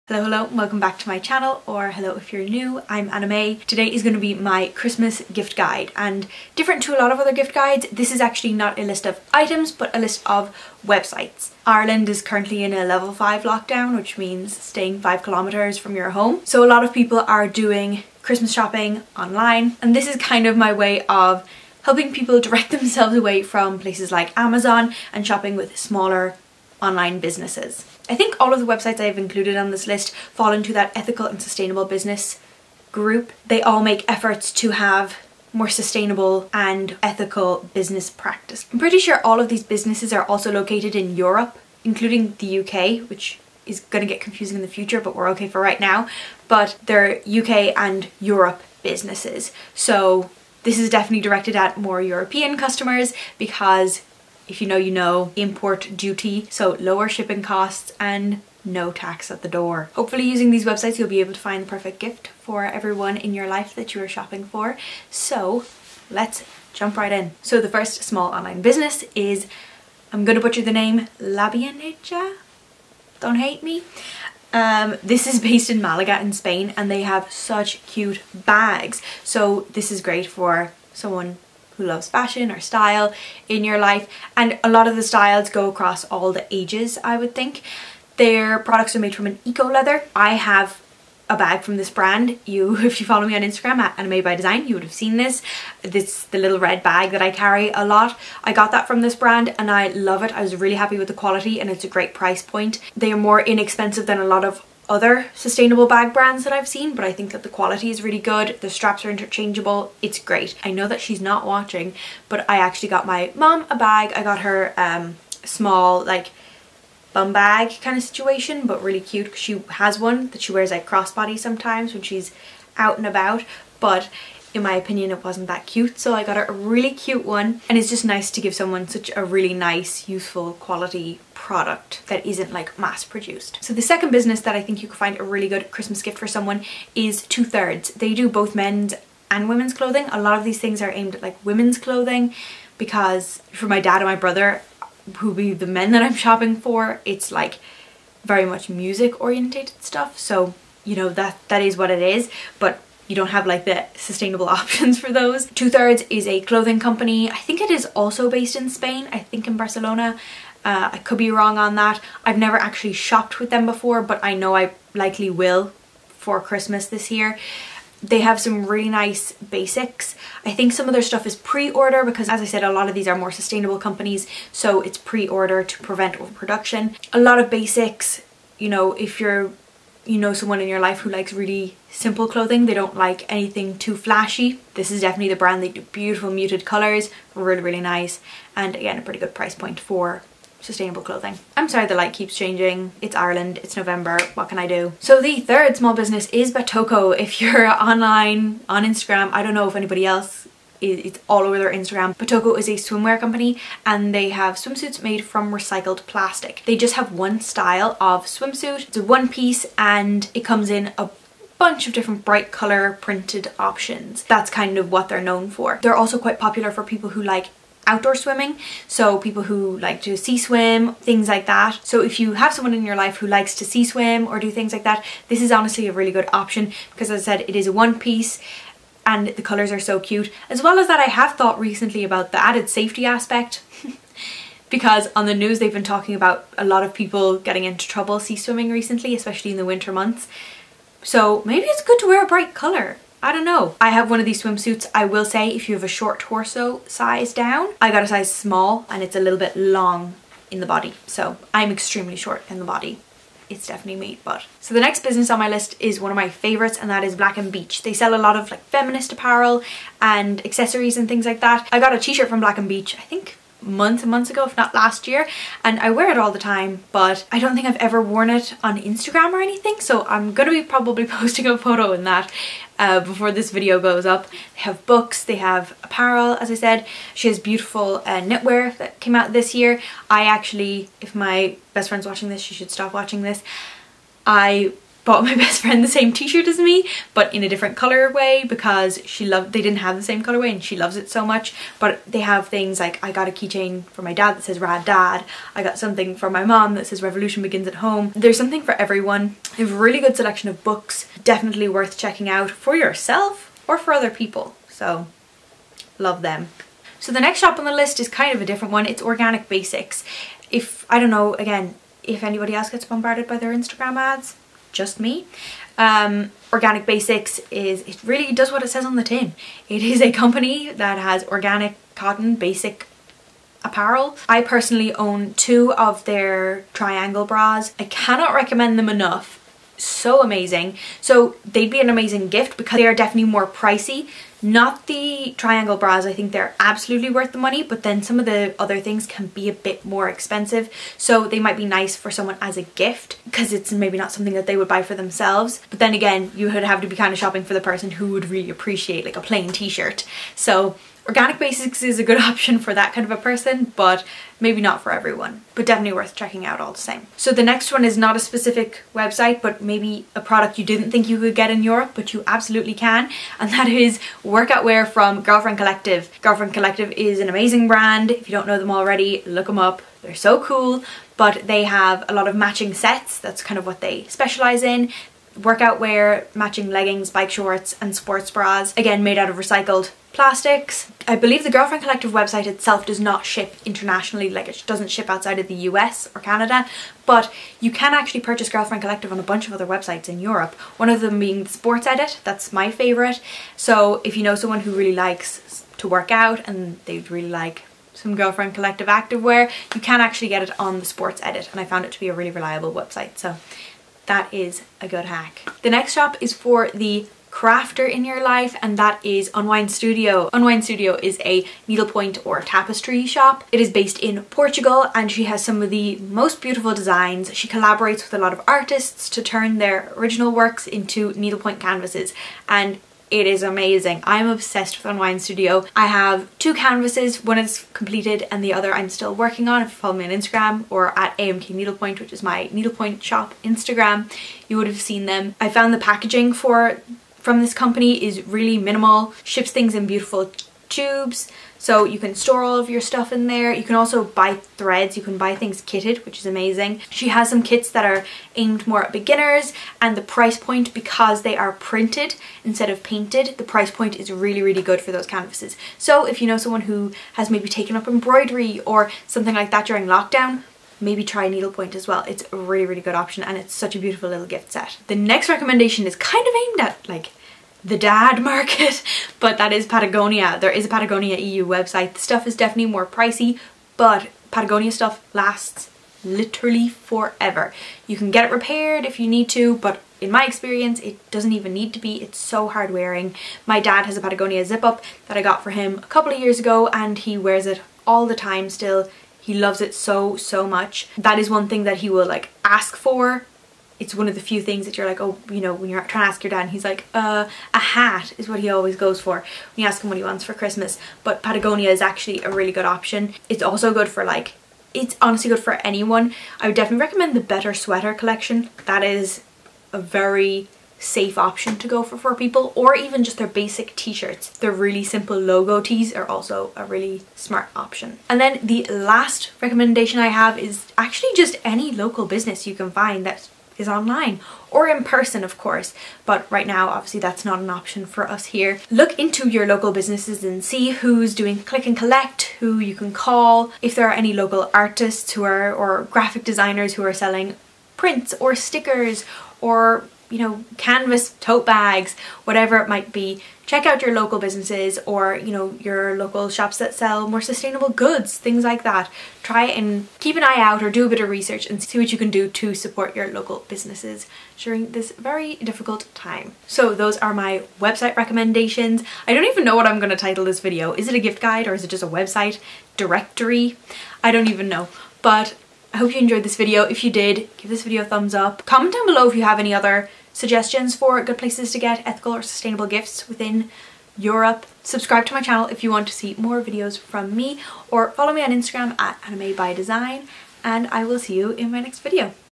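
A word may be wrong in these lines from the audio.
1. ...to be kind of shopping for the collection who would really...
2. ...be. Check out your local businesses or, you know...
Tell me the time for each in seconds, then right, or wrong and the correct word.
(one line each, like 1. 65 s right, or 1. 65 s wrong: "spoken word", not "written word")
1. 346 s wrong: "person", not "collection"
2. 542 s right.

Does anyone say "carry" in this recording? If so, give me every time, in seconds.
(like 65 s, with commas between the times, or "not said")
97 s.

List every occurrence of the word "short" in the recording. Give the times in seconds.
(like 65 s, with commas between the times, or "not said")
245 s, 252 s, 377 s.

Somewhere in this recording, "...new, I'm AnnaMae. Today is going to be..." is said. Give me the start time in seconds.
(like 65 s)
2 s.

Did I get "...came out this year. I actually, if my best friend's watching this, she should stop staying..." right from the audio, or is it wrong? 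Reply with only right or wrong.
wrong.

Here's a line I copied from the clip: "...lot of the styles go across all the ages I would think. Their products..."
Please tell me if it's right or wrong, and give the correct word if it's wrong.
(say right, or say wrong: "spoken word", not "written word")
right.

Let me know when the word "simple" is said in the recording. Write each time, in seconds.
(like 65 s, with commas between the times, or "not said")
181 s, 514 s.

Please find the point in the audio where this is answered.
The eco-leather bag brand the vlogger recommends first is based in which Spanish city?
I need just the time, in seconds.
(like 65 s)
75 s.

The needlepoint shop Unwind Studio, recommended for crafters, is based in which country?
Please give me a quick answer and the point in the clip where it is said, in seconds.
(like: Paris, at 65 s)
Portugal, at 414 s.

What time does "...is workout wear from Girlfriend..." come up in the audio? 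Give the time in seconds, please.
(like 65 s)
363 s.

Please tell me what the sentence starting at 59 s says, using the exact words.
Hopefully using these websites you'll be able to find the perfect gift for everyone in your life that you are shopping for.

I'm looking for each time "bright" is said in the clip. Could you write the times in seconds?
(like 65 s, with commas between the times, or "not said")
212 s, 242 s.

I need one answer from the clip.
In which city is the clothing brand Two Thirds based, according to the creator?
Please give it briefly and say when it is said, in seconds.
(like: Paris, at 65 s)
Barcelona, at 159 s.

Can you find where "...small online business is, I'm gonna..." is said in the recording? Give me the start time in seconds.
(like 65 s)
68 s.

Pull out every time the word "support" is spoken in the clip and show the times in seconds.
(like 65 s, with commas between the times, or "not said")
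552 s.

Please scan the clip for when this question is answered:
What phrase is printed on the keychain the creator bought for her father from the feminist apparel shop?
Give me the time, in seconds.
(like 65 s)
294 s.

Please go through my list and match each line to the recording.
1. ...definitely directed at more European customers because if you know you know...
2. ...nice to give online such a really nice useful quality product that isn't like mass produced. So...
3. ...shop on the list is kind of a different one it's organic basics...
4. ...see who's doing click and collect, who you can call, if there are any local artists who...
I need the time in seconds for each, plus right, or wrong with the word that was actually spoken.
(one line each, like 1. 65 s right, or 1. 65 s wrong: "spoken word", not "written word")
1. 50 s right
2. 128 s wrong: "someone", not "online"
3. 307 s right
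4. 530 s right.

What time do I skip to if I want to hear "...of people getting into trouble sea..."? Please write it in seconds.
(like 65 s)
236 s.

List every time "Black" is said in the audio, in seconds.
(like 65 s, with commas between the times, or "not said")
257 s, 262 s.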